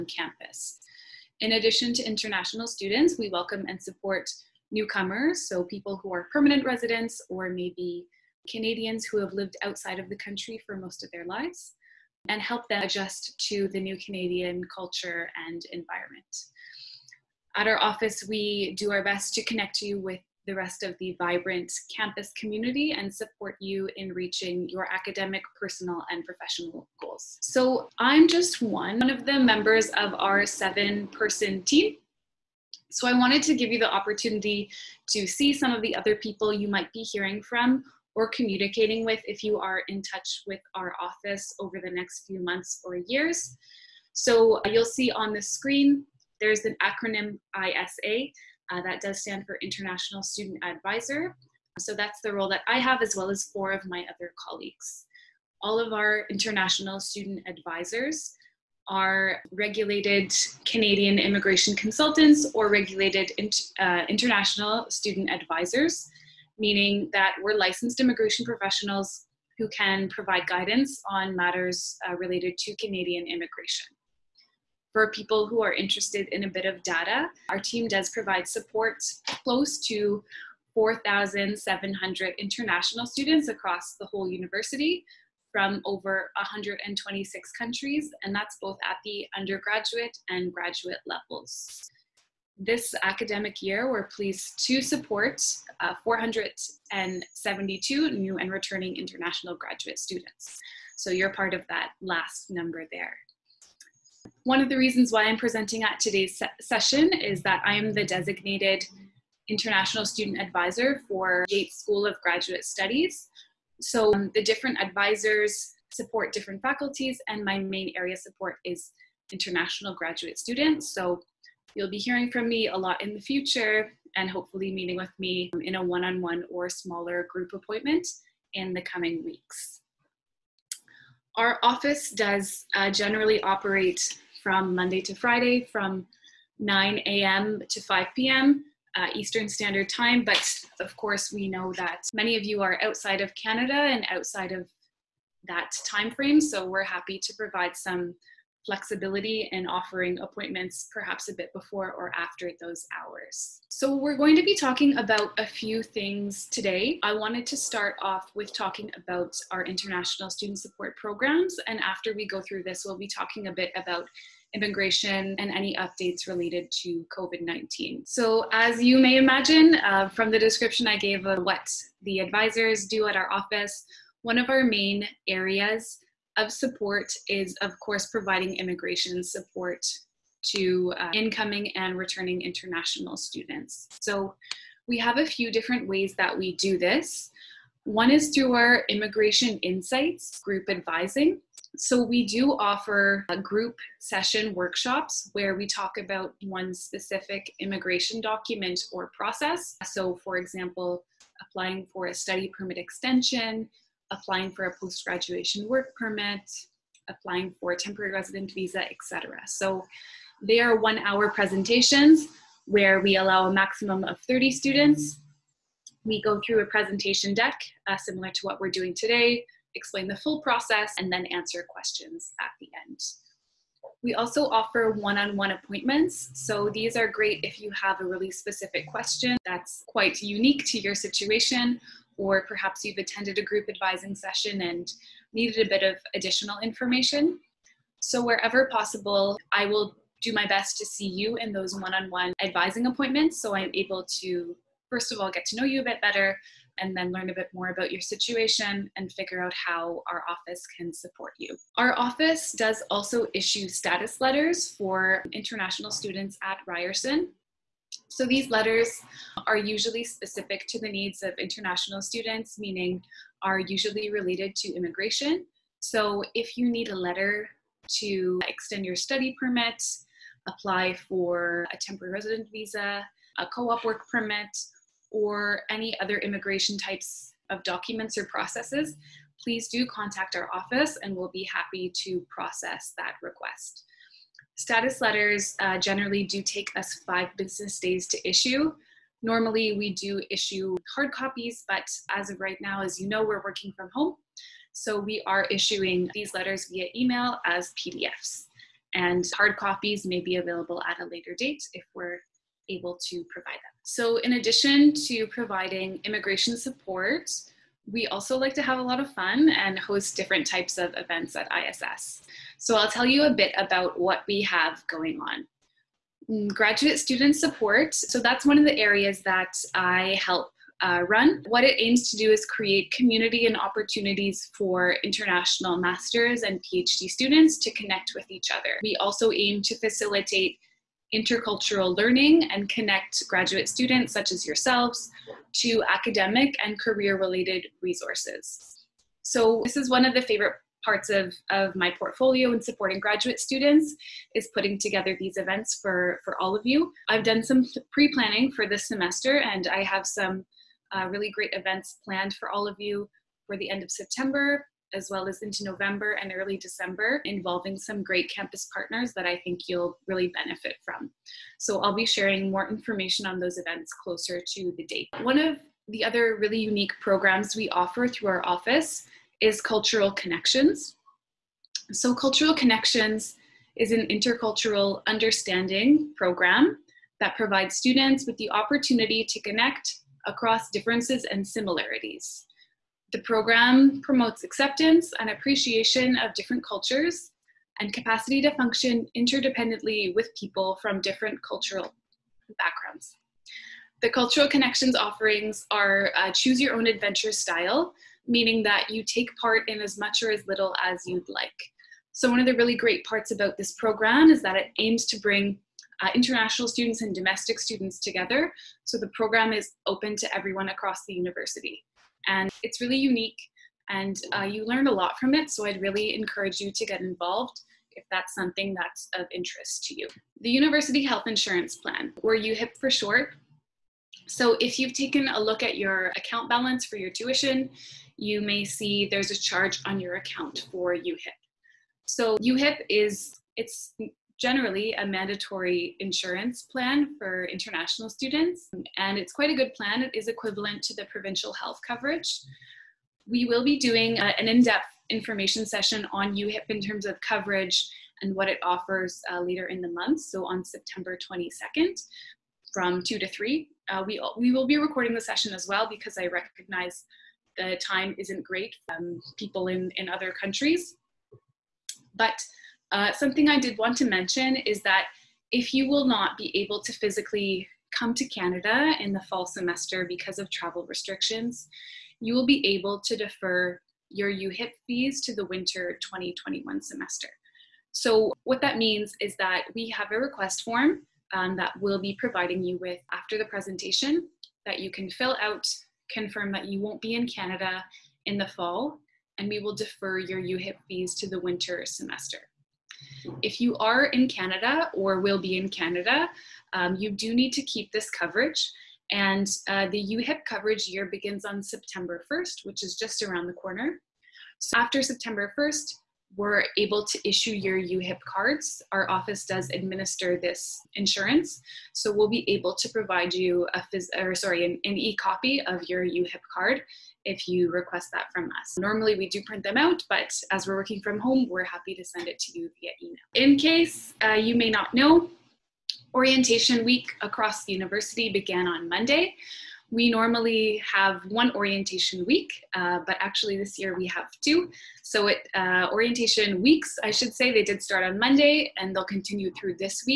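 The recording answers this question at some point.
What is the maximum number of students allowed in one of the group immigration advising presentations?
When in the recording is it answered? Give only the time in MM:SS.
03:34.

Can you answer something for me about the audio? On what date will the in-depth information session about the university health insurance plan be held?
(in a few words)
September 22nd.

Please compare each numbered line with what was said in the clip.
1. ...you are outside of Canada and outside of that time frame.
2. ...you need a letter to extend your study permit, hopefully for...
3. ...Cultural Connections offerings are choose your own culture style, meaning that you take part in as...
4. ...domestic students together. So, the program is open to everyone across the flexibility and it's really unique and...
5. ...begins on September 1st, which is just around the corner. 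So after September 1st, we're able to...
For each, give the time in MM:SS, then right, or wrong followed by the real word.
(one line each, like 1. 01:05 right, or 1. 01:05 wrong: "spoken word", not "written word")
1. 02:22 right
2. 04:26 wrong: "apply", not "hopefully"
3. 06:34 wrong: "adventure", not "culture"
4. 06:47 wrong: "university", not "flexibility"
5. 08:21 right.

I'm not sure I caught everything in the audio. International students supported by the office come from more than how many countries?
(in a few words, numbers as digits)
126.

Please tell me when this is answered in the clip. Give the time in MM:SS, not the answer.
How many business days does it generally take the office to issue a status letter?
04:47.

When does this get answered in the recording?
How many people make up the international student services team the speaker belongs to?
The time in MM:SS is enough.
00:30.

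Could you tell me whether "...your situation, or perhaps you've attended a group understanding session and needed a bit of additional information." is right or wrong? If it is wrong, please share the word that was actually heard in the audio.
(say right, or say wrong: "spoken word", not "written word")
wrong: "advising", not "understanding".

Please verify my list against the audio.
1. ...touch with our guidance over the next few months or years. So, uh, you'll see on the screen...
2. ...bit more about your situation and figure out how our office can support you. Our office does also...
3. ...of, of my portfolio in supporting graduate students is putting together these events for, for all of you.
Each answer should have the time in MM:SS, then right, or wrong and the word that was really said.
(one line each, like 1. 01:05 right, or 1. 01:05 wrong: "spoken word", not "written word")
1. 00:40 wrong: "office", not "guidance"
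2. 04:07 right
3. 05:41 right.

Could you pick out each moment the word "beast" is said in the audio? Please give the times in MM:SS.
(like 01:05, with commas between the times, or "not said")
not said.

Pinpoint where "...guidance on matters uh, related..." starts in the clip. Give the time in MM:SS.
01:10.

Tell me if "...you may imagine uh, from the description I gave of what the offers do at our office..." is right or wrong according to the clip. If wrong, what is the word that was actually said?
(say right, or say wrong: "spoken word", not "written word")
wrong: "advisors", not "offers".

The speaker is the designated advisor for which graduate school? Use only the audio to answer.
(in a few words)
Yeates School of Graduate Studies.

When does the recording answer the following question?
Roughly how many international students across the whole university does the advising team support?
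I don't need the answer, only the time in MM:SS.
01:20.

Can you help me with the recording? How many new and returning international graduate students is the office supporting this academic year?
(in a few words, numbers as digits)
472.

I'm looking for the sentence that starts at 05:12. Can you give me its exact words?
So I'll tell you a bit about what we have going on.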